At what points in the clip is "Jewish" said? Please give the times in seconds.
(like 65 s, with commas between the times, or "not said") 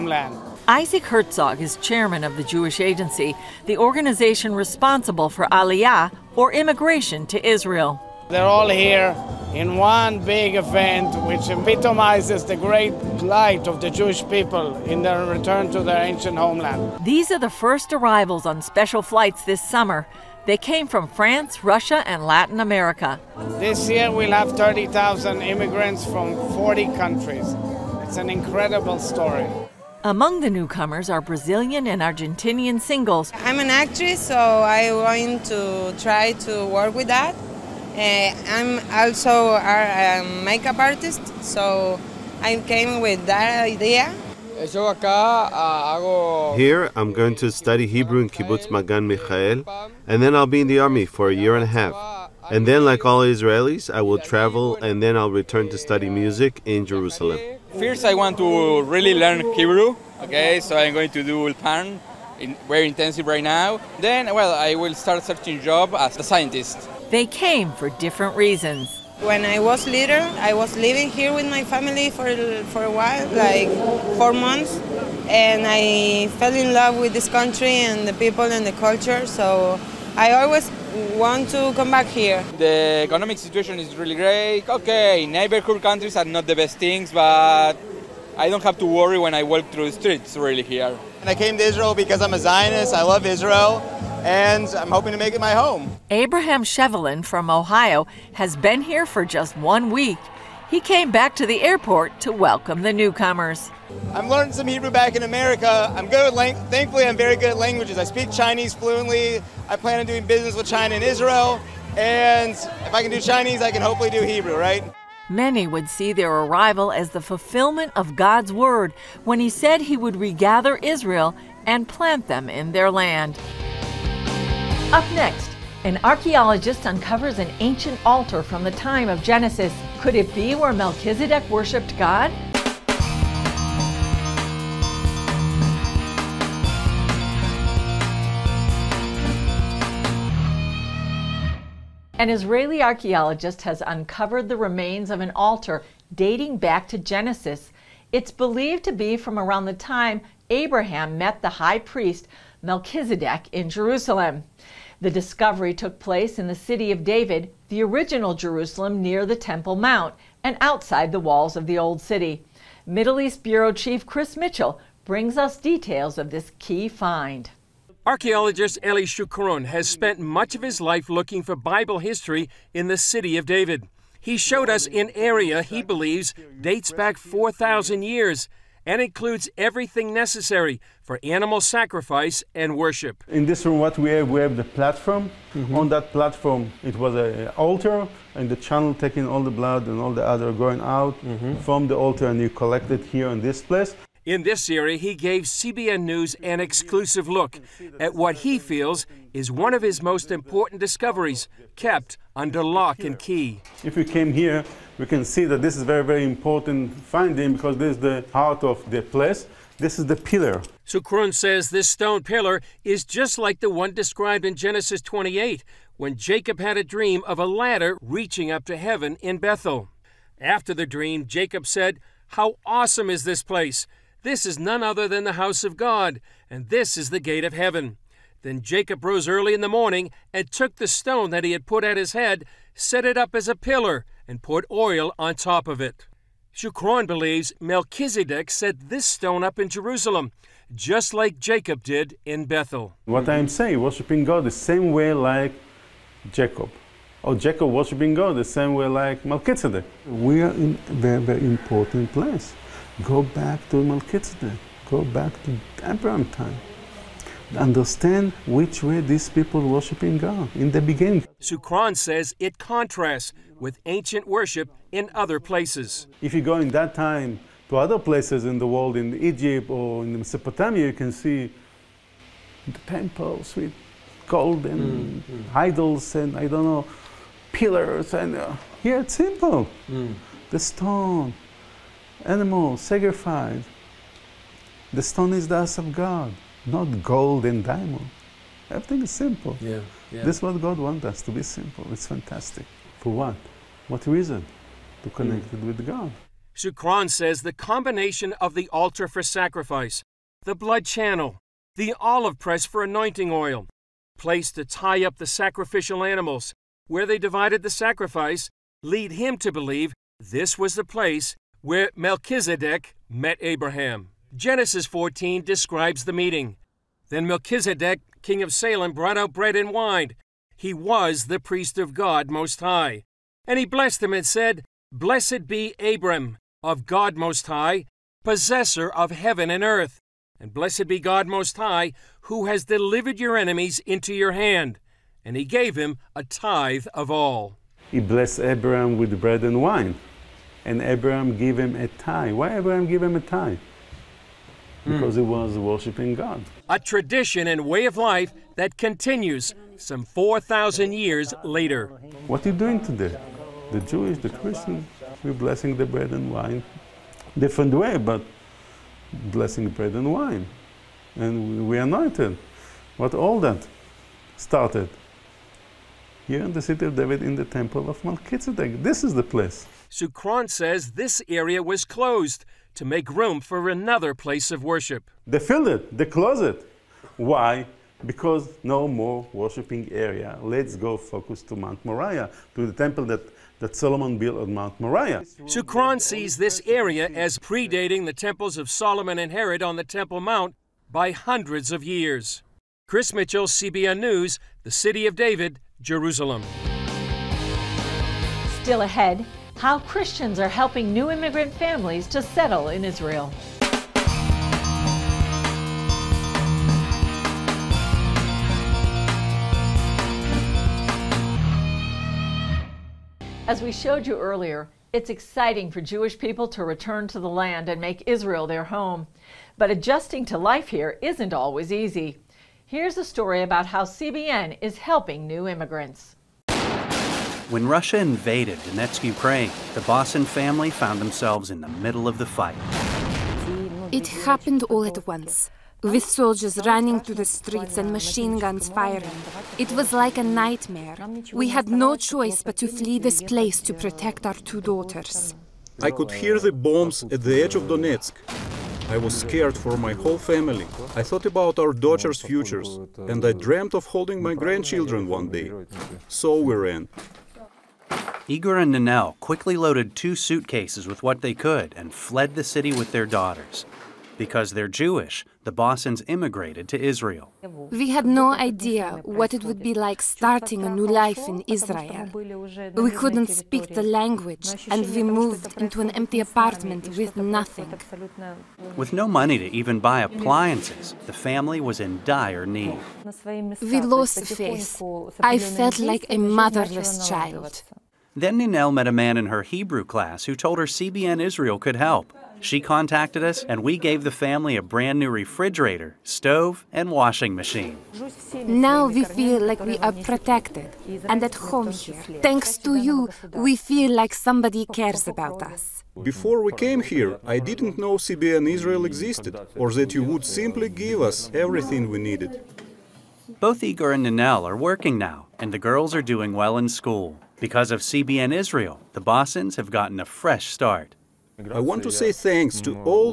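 2 s, 13 s, 353 s, 415 s, 464 s.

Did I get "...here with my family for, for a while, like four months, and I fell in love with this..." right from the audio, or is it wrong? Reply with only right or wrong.
right.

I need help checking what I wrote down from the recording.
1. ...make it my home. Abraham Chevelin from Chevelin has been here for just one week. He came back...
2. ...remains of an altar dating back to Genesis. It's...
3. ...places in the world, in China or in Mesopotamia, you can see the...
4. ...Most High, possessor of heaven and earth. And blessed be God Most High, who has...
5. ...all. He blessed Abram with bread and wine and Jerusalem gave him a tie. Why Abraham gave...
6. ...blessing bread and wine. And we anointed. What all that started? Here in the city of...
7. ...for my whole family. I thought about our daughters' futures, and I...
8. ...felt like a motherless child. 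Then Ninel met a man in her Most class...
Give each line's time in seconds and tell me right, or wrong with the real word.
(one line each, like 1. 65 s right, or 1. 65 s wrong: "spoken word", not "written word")
1. 95 s wrong: "Ohio", not "Chevelin"
2. 144 s right
3. 267 s wrong: "Egypt", not "China"
4. 327 s right
5. 337 s wrong: "Abraham", not "Jerusalem"
6. 359 s right
7. 449 s right
8. 485 s wrong: "Hebrew", not "Most".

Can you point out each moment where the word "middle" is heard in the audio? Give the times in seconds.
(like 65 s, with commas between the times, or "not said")
162 s, 431 s.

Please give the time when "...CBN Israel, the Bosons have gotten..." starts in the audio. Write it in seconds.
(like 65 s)
517 s.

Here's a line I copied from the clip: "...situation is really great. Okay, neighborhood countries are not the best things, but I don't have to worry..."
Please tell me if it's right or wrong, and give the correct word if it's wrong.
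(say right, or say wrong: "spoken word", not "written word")
right.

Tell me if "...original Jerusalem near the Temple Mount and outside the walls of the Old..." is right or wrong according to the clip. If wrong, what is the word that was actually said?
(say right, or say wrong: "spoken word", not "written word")
right.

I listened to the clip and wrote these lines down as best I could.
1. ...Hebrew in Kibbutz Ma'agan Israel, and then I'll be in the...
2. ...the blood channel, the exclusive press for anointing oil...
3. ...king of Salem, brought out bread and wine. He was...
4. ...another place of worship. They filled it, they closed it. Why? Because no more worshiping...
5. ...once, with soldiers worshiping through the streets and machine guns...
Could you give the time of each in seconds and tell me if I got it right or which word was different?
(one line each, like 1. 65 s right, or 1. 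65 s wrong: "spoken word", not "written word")
1. 47 s wrong: "Michael", not "Israel"
2. 300 s wrong: "olive", not "exclusive"
3. 318 s right
4. 373 s right
5. 435 s wrong: "running", not "worshiping".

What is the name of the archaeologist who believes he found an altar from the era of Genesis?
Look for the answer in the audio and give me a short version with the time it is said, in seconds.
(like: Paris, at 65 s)
Eli Shukron, at 168 s.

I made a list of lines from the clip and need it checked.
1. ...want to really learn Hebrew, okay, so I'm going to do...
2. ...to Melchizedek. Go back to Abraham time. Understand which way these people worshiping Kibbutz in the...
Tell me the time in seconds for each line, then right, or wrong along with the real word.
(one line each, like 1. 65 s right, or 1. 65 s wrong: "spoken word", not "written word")
1. 58 s right
2. 253 s wrong: "God", not "Kibbutz".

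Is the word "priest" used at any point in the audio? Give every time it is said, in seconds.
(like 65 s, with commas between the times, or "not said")
151 s, 321 s.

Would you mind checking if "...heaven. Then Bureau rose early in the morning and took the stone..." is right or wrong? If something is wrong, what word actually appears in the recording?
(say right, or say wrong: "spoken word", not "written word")
wrong: "Jacob", not "Bureau".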